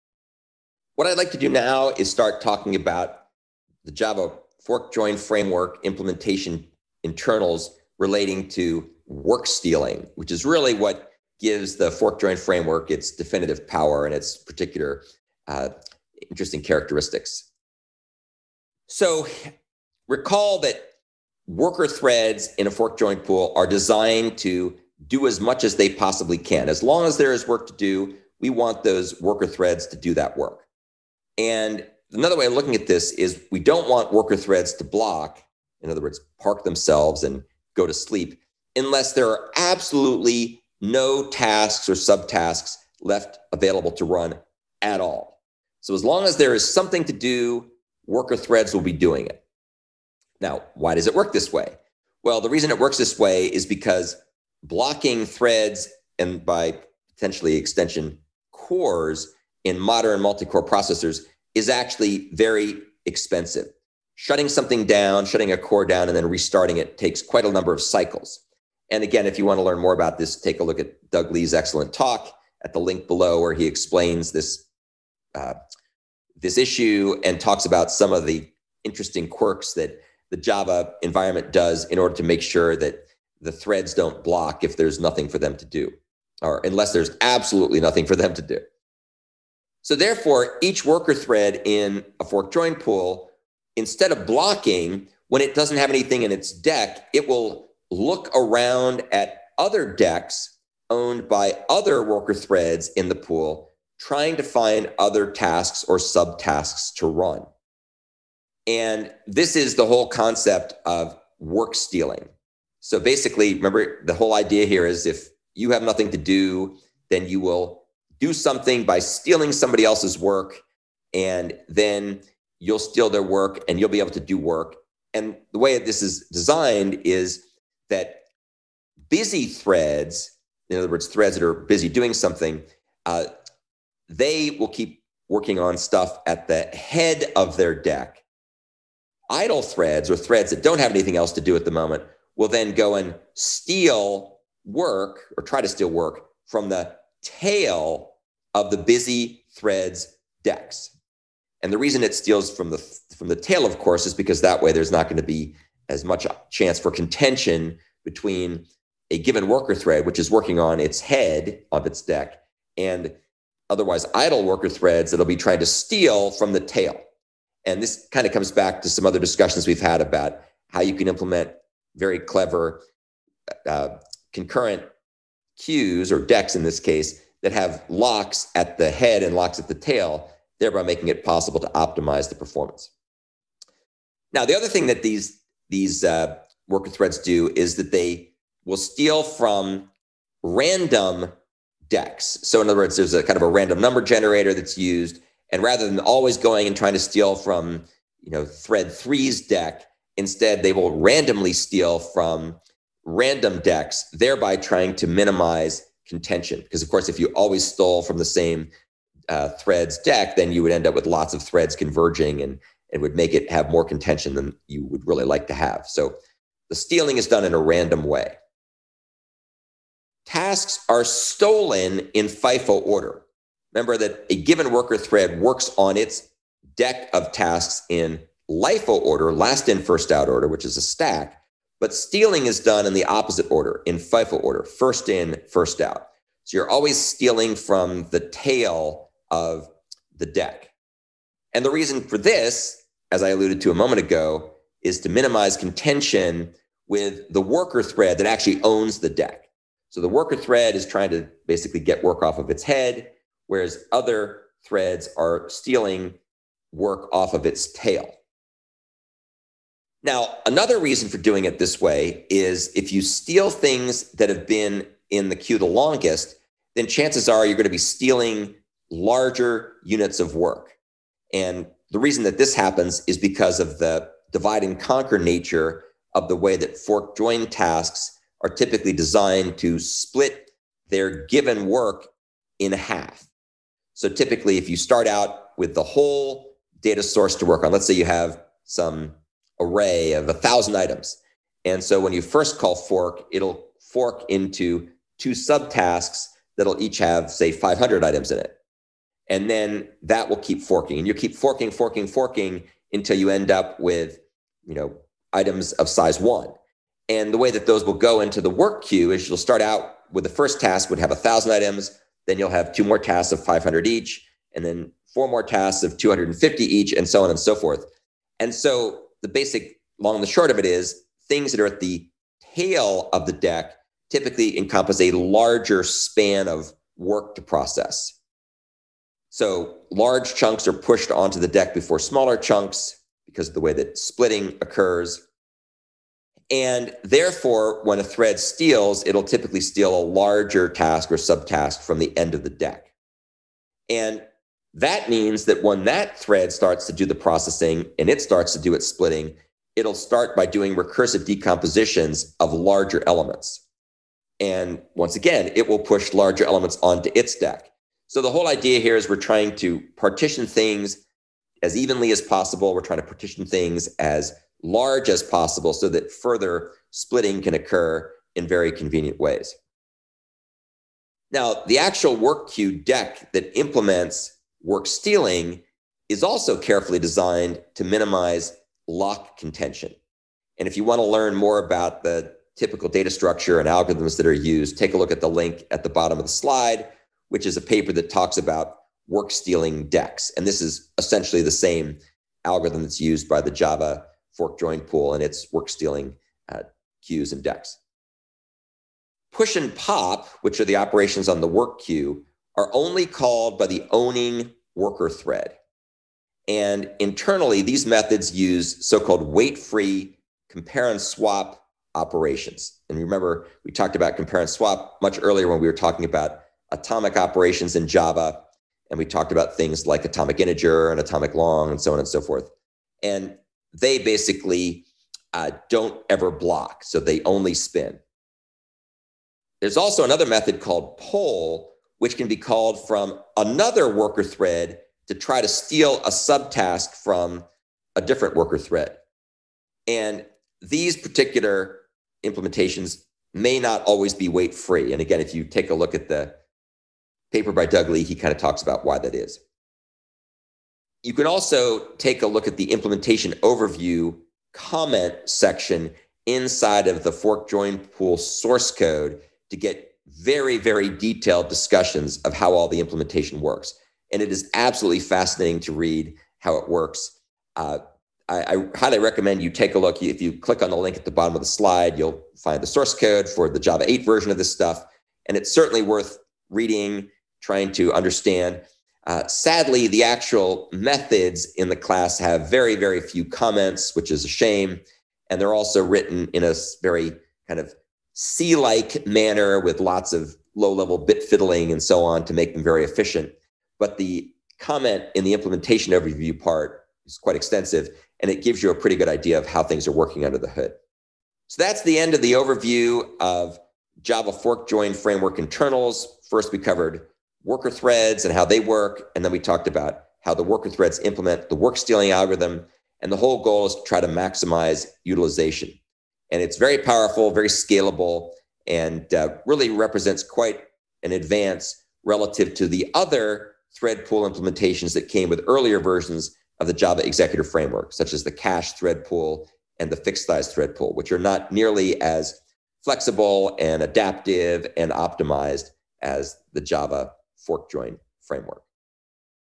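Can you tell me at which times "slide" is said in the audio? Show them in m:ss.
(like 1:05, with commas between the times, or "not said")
6:26, 7:51.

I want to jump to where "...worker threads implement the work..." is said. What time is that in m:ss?
8:30.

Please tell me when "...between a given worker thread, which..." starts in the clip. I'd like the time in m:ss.
2:38.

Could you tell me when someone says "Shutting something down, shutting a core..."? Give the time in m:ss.
1:04.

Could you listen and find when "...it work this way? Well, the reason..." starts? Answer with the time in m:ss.
0:51.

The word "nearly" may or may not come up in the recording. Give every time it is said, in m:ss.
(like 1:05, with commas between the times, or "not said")
8:51.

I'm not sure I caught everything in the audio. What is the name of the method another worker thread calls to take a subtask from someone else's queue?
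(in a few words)
poll.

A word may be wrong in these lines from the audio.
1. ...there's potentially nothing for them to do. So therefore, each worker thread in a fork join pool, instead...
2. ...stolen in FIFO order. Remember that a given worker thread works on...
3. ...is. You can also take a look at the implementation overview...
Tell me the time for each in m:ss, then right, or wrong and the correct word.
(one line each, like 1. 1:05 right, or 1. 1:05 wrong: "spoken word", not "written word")
1. 1:26 wrong: "absolutely", not "potentially"
2. 3:41 right
3. 7:29 right.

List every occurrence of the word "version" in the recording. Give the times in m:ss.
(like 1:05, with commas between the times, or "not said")
7:54, 8:45.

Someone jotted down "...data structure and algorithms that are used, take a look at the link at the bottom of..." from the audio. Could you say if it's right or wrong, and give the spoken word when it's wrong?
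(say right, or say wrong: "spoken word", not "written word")
right.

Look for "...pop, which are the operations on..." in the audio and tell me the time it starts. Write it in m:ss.
6:39.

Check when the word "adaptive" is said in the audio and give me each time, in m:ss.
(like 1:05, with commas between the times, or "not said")
8:53.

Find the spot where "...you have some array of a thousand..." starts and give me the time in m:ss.
4:47.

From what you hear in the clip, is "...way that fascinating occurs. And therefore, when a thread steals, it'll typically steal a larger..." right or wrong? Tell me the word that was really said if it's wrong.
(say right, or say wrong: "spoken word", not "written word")
wrong: "splitting", not "fascinating".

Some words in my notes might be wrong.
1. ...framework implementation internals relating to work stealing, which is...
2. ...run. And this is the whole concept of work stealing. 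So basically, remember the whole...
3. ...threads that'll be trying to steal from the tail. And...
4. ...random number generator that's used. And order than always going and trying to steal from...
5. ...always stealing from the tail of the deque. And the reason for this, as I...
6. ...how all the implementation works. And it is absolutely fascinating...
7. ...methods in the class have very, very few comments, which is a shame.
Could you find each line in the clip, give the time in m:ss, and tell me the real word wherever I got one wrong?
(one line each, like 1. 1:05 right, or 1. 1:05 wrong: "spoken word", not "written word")
1. 0:05 right
2. 1:47 right
3. 2:44 right
4. 3:13 wrong: "rather", not "order"
5. 3:56 right
6. 7:42 right
7. 8:00 right.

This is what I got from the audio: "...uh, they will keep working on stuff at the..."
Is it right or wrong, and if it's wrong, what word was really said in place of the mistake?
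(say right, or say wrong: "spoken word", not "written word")
right.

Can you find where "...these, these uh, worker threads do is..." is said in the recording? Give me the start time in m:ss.
3:05.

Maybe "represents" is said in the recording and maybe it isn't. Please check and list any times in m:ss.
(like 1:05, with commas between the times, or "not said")
8:39.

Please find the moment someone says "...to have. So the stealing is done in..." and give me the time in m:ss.
3:35.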